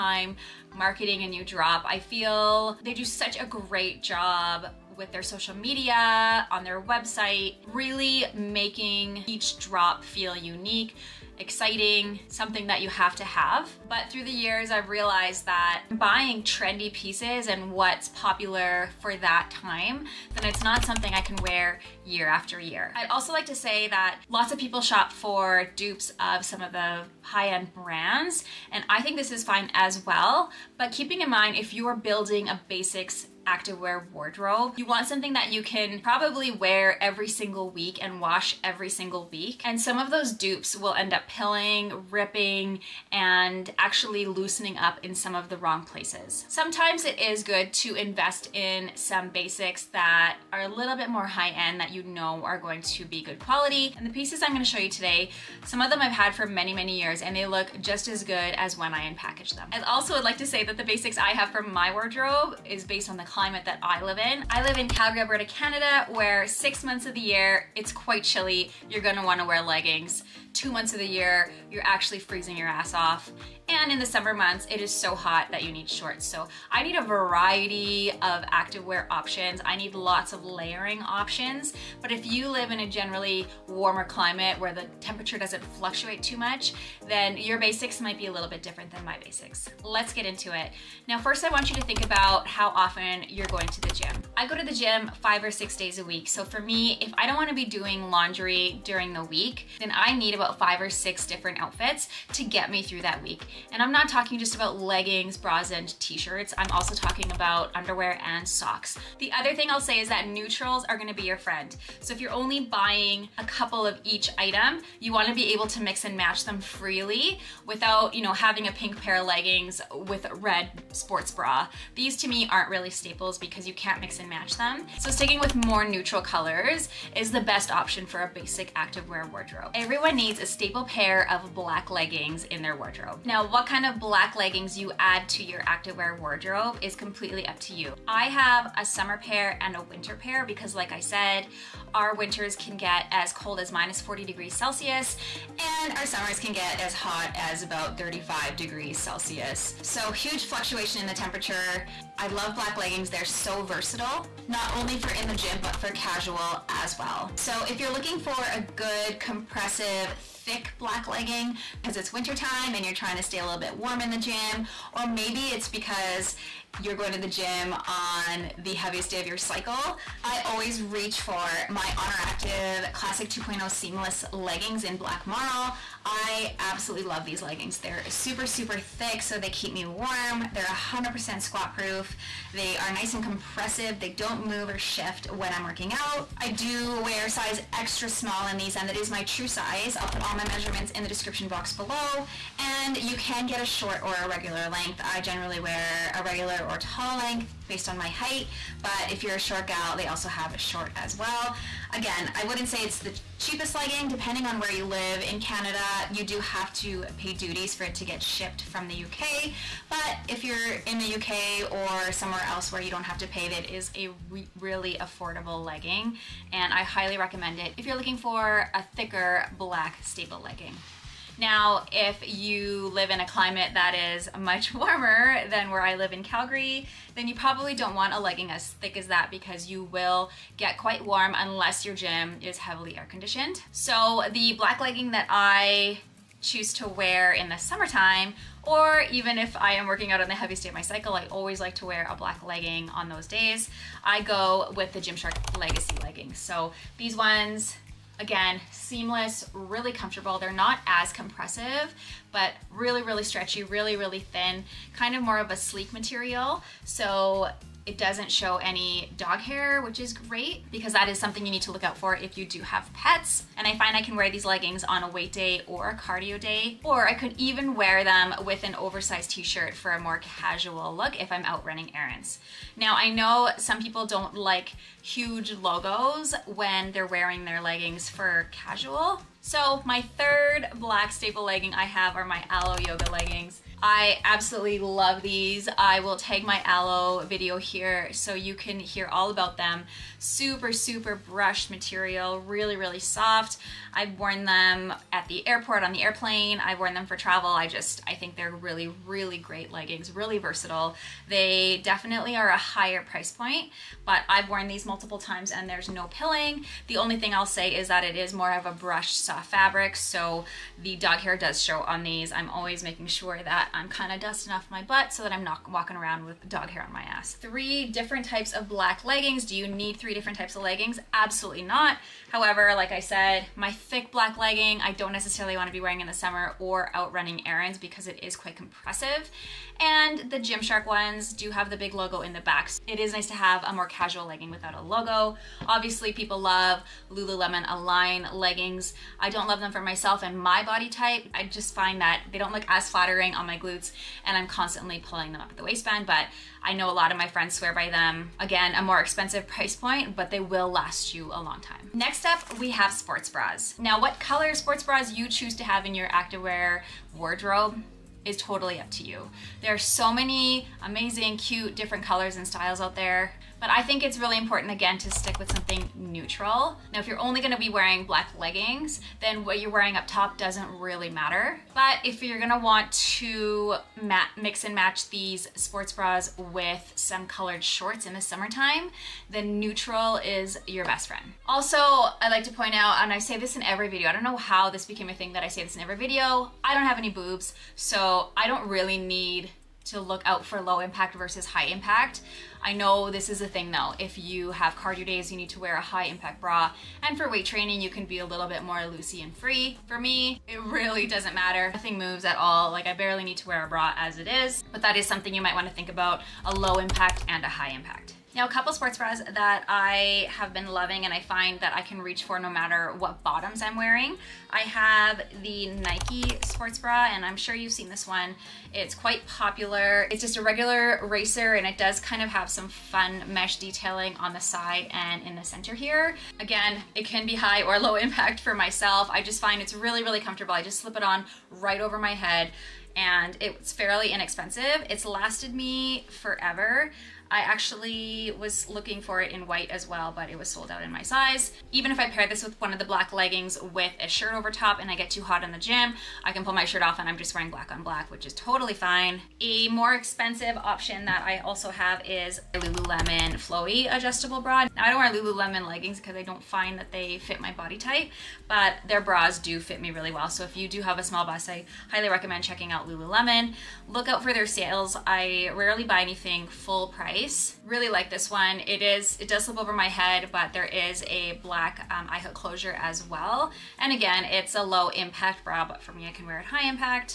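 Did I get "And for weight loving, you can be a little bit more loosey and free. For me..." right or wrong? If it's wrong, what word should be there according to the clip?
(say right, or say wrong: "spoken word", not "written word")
wrong: "training", not "loving".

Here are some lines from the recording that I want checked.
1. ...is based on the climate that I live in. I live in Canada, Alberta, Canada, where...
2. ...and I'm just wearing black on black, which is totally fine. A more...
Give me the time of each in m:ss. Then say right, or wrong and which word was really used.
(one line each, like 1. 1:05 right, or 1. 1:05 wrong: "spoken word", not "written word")
1. 1:02 wrong: "Calgary", not "Canada"
2. 7:26 right.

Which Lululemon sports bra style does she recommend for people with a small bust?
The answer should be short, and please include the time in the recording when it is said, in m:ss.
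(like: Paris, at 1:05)
Flowy adjustable bra, at 7:33.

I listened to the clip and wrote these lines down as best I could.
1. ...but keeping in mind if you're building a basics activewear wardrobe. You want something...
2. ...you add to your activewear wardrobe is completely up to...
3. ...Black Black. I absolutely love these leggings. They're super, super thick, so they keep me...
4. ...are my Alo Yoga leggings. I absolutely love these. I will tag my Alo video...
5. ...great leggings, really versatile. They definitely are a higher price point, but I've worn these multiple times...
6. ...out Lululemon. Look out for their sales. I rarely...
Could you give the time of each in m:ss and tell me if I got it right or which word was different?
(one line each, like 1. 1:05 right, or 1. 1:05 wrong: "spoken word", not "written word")
1. 0:30 right
2. 2:14 right
3. 2:54 wrong: "Marl", not "Black"
4. 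4:42 right
5. 4:59 right
6. 7:42 right.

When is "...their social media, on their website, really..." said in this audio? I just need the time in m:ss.
0:05.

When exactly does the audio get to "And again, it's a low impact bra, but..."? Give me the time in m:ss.
7:53.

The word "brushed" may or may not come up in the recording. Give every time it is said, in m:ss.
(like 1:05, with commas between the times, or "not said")
4:51, 5:08.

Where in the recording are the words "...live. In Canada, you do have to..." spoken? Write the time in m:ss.
3:24.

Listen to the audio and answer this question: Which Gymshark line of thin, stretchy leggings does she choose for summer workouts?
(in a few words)
Legacy.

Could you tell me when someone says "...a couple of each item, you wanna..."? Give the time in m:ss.
1:53.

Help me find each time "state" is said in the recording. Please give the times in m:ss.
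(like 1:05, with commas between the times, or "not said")
4:00.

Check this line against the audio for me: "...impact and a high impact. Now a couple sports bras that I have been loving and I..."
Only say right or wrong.
right.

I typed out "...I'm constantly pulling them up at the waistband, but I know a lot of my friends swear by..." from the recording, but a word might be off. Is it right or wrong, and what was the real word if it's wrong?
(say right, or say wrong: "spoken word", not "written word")
right.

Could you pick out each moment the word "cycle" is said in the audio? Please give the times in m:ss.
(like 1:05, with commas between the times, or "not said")
2:49, 4:00.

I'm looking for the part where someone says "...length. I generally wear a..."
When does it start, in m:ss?
3:14.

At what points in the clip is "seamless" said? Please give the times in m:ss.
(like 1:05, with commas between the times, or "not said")
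2:53, 4:08.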